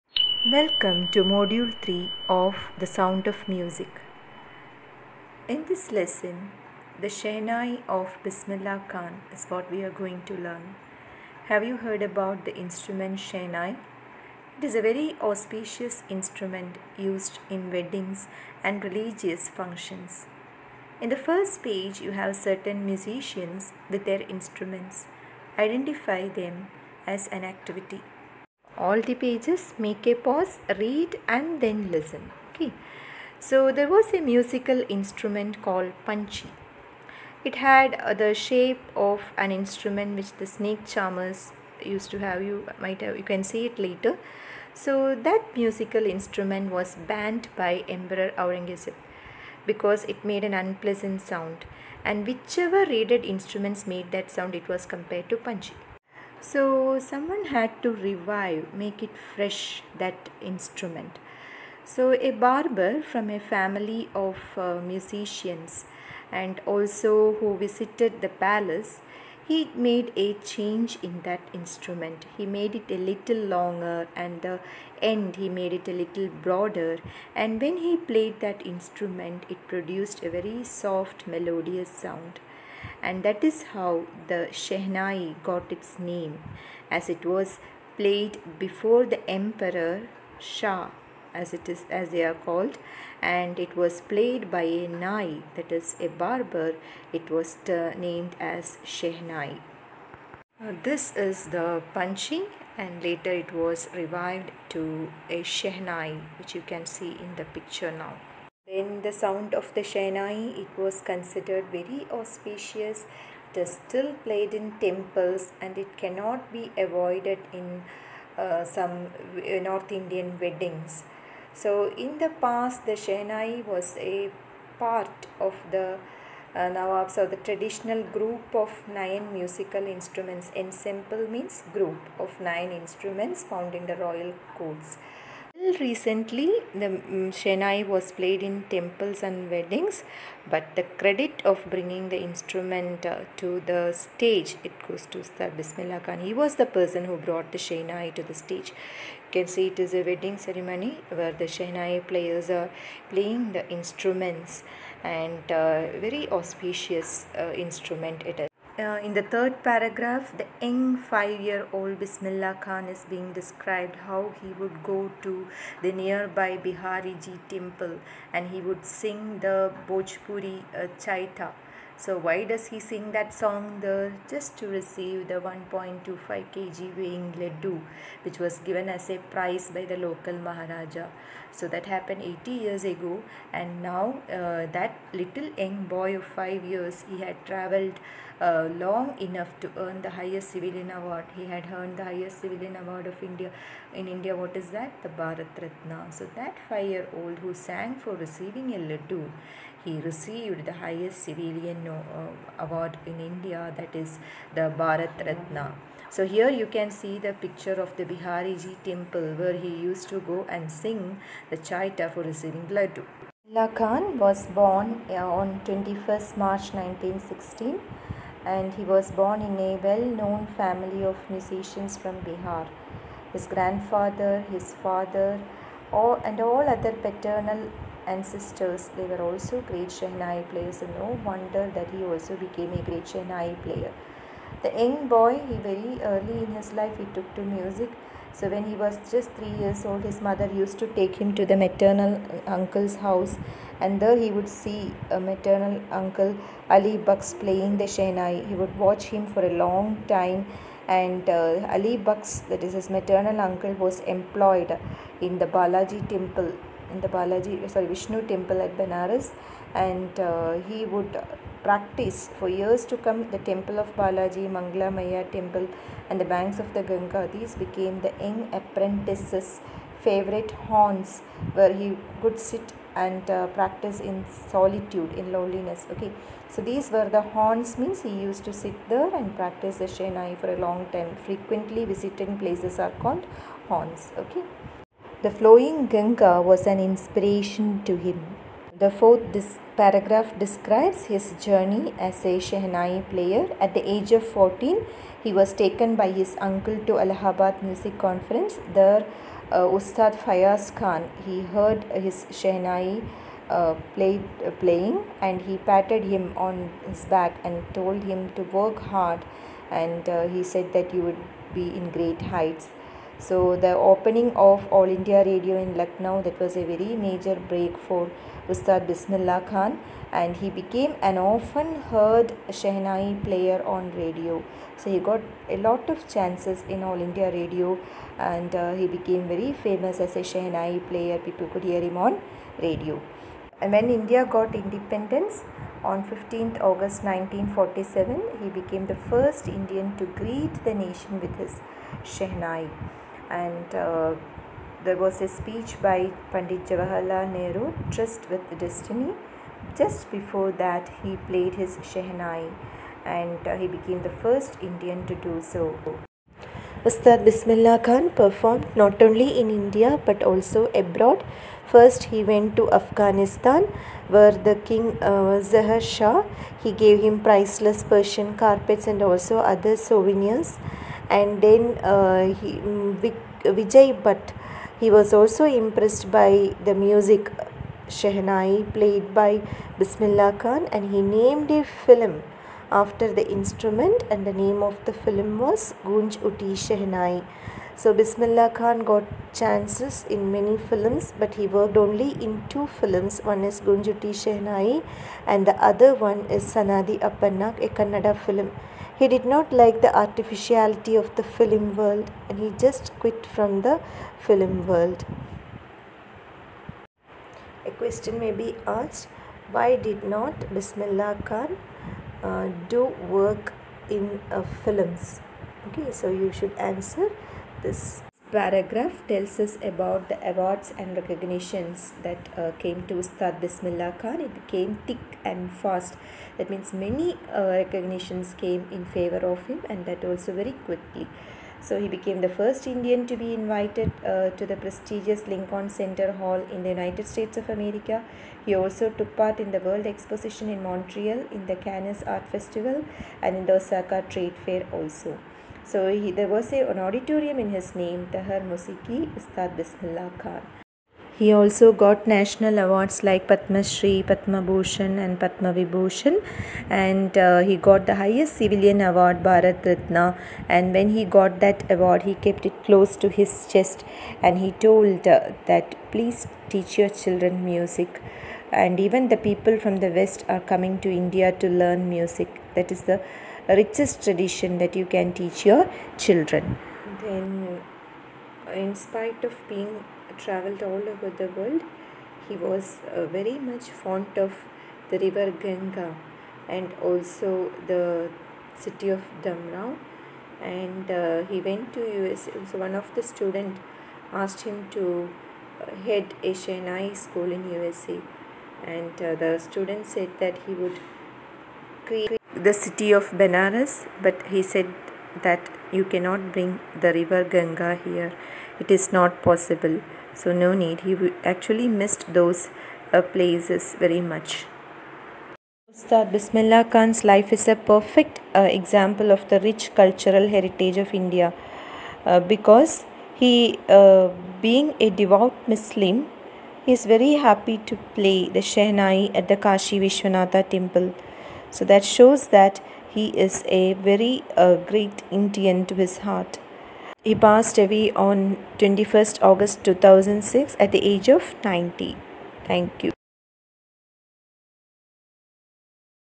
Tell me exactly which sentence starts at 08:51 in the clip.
So that shows that he is a very uh, great Indian to his heart.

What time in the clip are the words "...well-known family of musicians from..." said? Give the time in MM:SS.
03:39.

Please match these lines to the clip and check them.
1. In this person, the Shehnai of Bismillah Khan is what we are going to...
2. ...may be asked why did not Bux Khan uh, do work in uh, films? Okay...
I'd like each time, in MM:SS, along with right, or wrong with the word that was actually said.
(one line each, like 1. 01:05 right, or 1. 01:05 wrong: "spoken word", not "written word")
1. 00:05 wrong: "lesson", not "person"
2. 06:48 wrong: "Bismillah", not "Bux".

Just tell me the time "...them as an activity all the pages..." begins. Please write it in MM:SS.
00:26.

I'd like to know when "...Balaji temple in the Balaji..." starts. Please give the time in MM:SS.
04:15.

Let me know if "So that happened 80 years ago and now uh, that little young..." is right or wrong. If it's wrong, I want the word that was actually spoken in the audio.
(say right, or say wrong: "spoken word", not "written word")
right.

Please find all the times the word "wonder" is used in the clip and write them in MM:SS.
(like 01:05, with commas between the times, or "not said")
03:51.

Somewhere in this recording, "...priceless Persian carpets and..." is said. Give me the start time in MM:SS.
06:07.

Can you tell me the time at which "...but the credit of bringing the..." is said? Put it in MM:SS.
02:20.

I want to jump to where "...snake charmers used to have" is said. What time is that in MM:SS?
00:40.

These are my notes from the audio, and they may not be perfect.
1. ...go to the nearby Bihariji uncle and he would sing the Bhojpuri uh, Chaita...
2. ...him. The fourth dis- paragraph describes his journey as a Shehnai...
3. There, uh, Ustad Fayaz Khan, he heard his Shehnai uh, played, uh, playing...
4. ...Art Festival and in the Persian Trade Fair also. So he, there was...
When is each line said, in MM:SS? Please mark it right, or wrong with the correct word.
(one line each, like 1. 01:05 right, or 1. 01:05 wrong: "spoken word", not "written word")
1. 02:44 wrong: "temple", not "uncle"
2. 04:47 right
3. 04:58 right
4. 07:22 wrong: "Osaka", not "Persian".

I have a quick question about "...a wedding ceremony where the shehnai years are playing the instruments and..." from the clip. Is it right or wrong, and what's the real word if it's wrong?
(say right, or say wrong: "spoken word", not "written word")
wrong: "players", not "years".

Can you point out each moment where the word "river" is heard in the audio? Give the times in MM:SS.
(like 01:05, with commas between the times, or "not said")
08:04, 08:26.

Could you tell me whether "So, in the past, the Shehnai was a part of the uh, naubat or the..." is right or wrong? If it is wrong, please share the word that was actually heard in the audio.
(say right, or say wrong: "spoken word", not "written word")
right.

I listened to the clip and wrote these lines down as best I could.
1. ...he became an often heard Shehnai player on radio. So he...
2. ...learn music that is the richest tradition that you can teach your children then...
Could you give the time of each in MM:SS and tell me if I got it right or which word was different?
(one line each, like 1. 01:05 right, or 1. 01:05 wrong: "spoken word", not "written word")
1. 05:20 right
2. 07:51 right.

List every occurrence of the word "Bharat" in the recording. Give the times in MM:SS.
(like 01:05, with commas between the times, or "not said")
03:15, 03:24, 07:39.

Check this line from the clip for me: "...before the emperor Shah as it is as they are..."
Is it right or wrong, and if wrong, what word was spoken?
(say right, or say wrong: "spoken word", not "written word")
right.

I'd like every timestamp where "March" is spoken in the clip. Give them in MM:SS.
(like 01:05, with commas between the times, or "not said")
03:36.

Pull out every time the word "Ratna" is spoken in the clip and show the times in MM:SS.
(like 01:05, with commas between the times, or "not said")
03:15, 03:25, 07:39.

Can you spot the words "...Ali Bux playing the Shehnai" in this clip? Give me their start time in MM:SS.
04:06.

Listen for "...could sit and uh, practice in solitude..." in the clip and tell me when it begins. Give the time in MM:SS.
04:32.